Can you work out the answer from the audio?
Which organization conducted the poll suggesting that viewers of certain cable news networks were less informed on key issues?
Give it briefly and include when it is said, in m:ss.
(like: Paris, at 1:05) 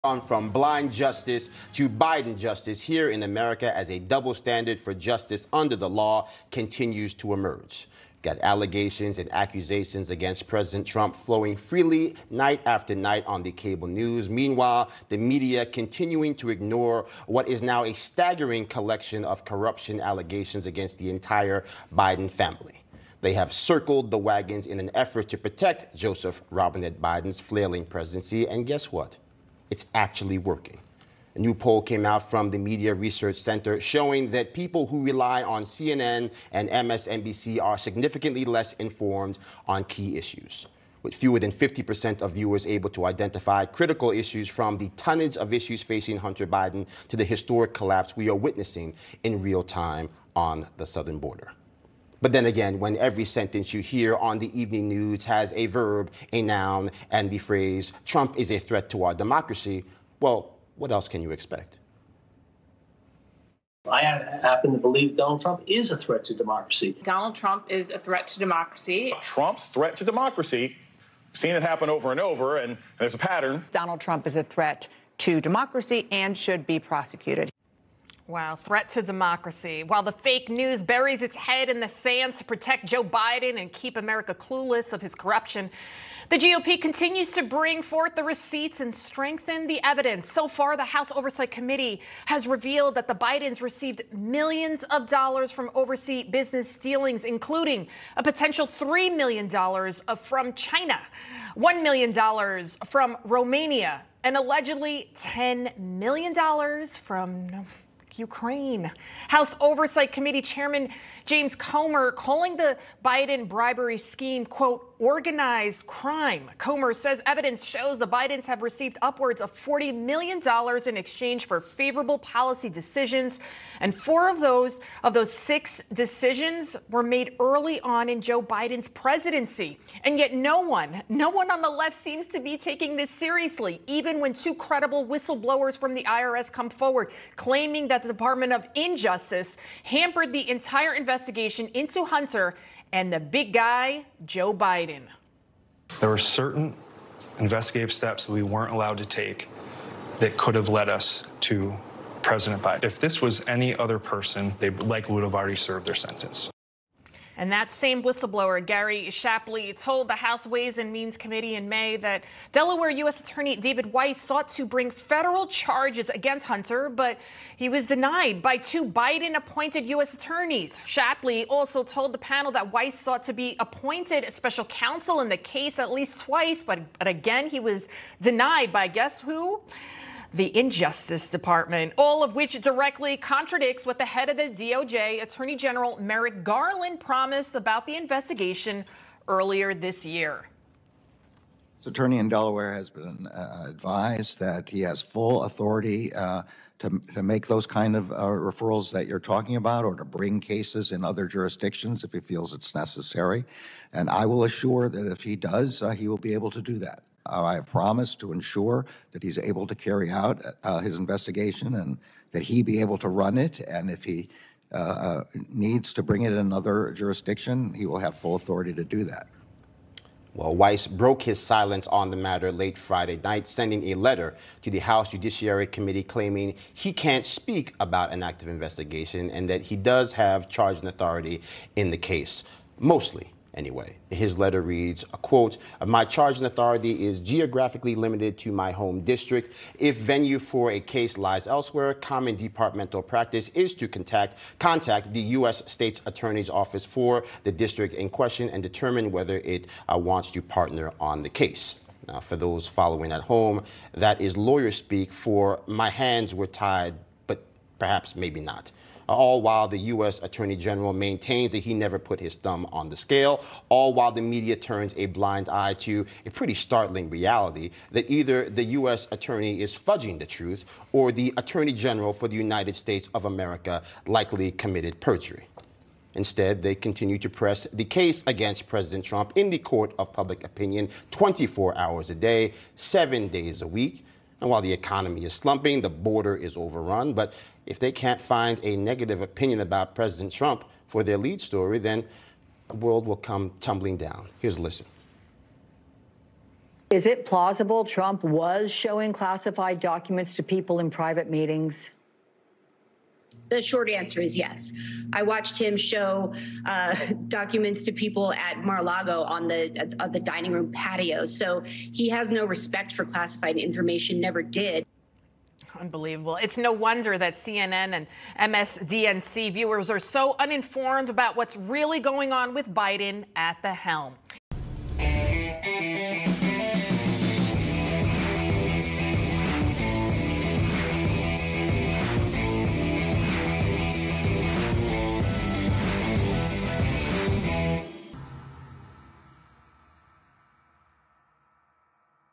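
Media Research Center, at 0:32.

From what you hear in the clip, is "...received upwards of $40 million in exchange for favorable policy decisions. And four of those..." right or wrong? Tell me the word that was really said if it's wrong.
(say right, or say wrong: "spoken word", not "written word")
right.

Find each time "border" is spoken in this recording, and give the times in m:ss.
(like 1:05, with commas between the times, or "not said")
0:51, 4:45.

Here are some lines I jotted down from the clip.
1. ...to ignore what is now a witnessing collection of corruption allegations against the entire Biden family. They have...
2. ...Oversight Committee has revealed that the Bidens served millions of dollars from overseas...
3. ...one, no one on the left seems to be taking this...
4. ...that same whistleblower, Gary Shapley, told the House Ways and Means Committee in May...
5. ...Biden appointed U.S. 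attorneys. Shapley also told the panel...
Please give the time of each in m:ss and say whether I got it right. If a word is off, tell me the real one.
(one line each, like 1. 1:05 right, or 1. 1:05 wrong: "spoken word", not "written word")
1. 0:16 wrong: "staggering", not "witnessing"
2. 1:31 wrong: "received", not "served"
3. 2:10 right
4. 2:37 right
5. 2:48 right.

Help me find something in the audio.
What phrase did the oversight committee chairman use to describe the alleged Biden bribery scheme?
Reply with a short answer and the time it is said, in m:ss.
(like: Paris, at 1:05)
organized crime, at 1:55.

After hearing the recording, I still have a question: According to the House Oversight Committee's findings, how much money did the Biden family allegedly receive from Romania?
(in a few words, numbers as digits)
$1 million.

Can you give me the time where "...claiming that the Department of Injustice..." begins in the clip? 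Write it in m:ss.
2:17.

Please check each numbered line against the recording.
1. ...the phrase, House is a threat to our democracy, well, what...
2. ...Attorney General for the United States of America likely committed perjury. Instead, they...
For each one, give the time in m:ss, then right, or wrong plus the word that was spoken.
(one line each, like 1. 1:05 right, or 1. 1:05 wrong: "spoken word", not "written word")
1. 0:57 wrong: "Trump", not "House"
2. 4:31 right.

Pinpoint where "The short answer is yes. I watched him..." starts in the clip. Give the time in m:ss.
5:03.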